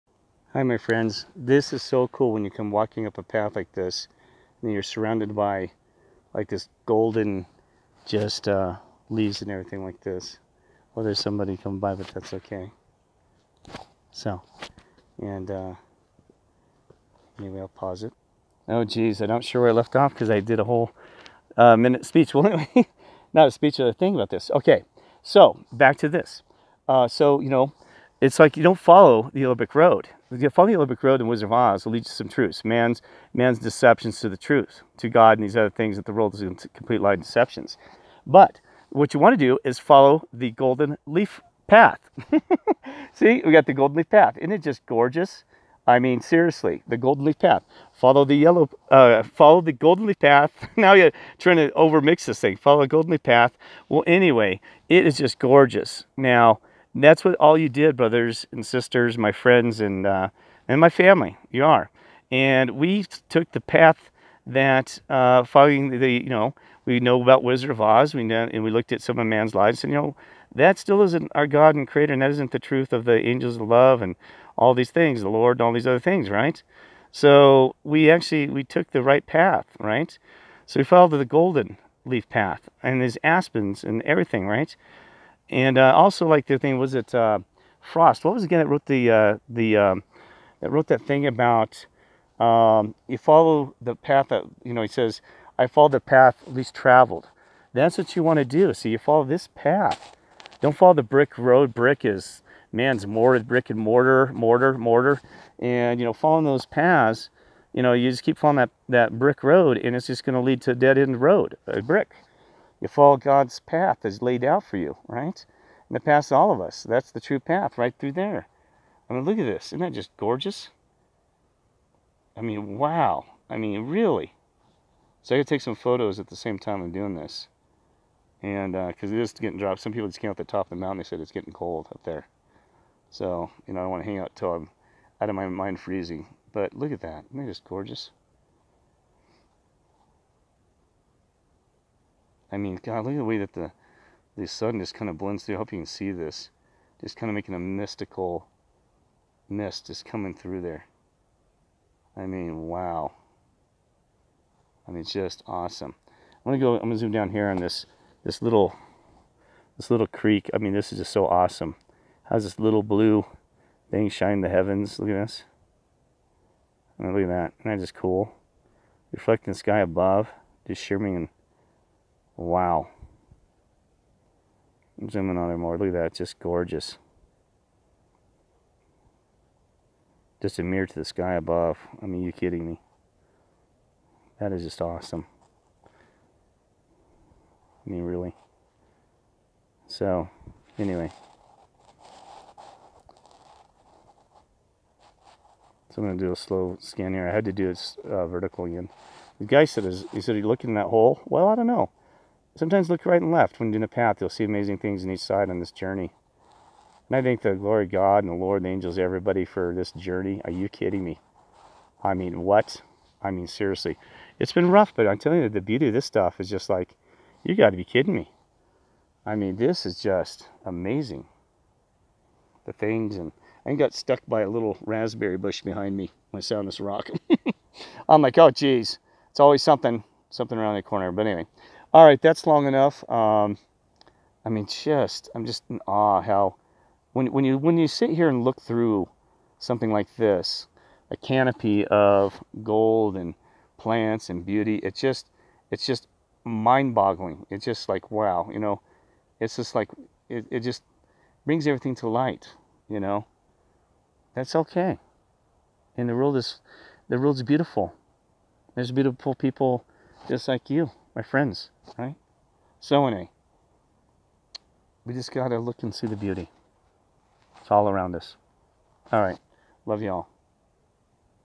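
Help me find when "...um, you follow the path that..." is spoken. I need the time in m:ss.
1:32.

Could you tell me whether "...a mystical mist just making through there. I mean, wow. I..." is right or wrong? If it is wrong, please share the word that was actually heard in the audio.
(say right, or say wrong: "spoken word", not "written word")
wrong: "coming", not "making".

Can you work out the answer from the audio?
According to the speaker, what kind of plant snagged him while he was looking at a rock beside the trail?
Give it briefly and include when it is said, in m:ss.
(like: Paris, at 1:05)
raspberry bush, at 3:44.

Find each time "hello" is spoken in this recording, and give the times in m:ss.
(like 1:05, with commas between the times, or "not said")
not said.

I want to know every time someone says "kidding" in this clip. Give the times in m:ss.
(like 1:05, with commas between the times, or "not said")
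3:02, 3:30, 3:37.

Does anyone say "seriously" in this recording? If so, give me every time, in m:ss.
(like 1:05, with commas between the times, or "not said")
0:46, 3:33.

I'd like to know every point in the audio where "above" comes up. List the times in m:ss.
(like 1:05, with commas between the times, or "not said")
2:49, 3:01.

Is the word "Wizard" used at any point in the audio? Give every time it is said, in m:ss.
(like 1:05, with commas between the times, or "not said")
0:31, 1:07.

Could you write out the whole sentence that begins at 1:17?
So we actually we took the right path, right?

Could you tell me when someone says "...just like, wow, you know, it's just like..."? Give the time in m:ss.
4:07.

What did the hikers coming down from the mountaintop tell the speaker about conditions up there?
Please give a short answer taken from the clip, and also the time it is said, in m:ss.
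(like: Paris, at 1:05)
getting cold, at 2:11.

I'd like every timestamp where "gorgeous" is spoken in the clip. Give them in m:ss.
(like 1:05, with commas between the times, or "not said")
0:44, 0:55, 2:00, 2:17, 2:56.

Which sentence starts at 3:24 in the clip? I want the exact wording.
You'll see amazing things on each side on this journey.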